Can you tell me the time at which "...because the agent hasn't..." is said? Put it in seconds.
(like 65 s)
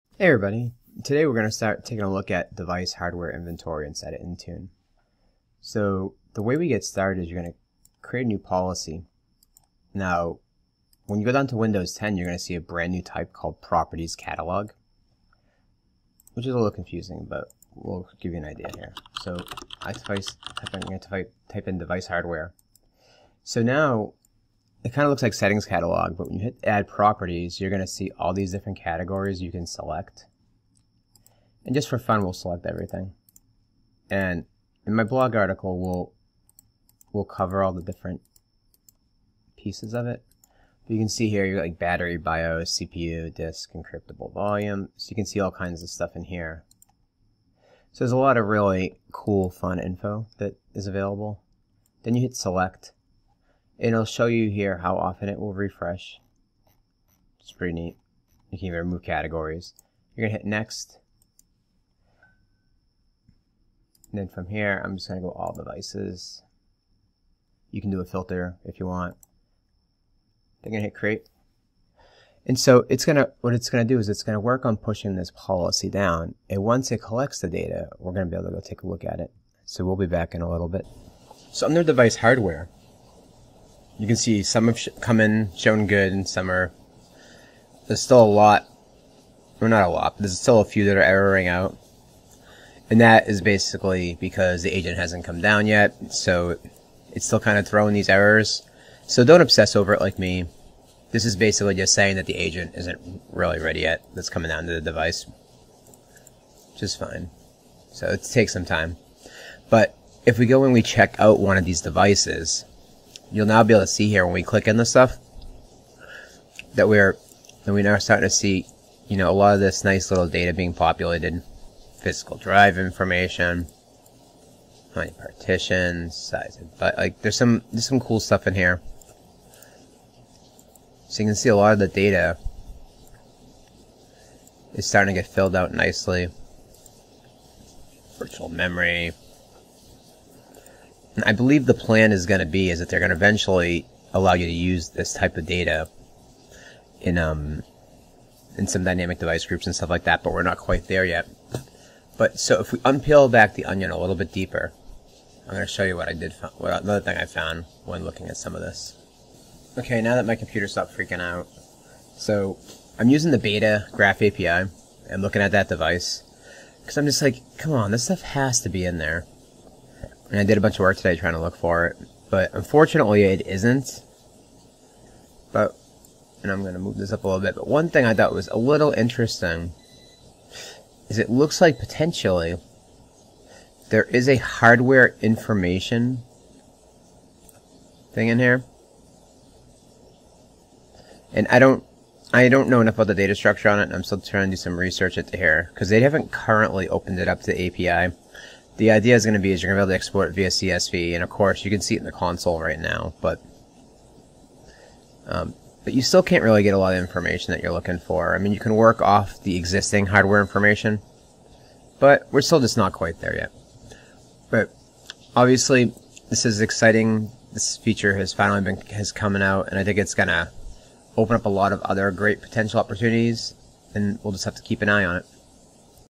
94 s.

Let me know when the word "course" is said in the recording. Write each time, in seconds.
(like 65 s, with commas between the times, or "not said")
201 s.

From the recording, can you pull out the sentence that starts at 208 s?
I mean, you can work off the existing hardware information, but we're still just not quite there yet.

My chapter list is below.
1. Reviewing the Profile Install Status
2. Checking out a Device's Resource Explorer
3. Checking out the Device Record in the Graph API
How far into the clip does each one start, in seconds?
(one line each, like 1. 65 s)
1. 80 s
2. 108 s
3. 155 s.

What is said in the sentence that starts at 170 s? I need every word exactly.
And I did a bunch of work today trying to look for it.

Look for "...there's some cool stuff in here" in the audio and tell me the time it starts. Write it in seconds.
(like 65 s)
127 s.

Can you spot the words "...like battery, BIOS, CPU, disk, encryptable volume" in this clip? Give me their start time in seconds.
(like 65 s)
41 s.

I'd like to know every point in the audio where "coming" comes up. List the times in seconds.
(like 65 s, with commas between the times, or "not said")
104 s, 219 s.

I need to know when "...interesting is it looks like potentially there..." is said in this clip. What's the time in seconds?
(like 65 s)
178 s.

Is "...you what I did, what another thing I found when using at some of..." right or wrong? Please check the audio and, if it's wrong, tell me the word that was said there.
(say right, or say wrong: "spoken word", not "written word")
wrong: "looking", not "using".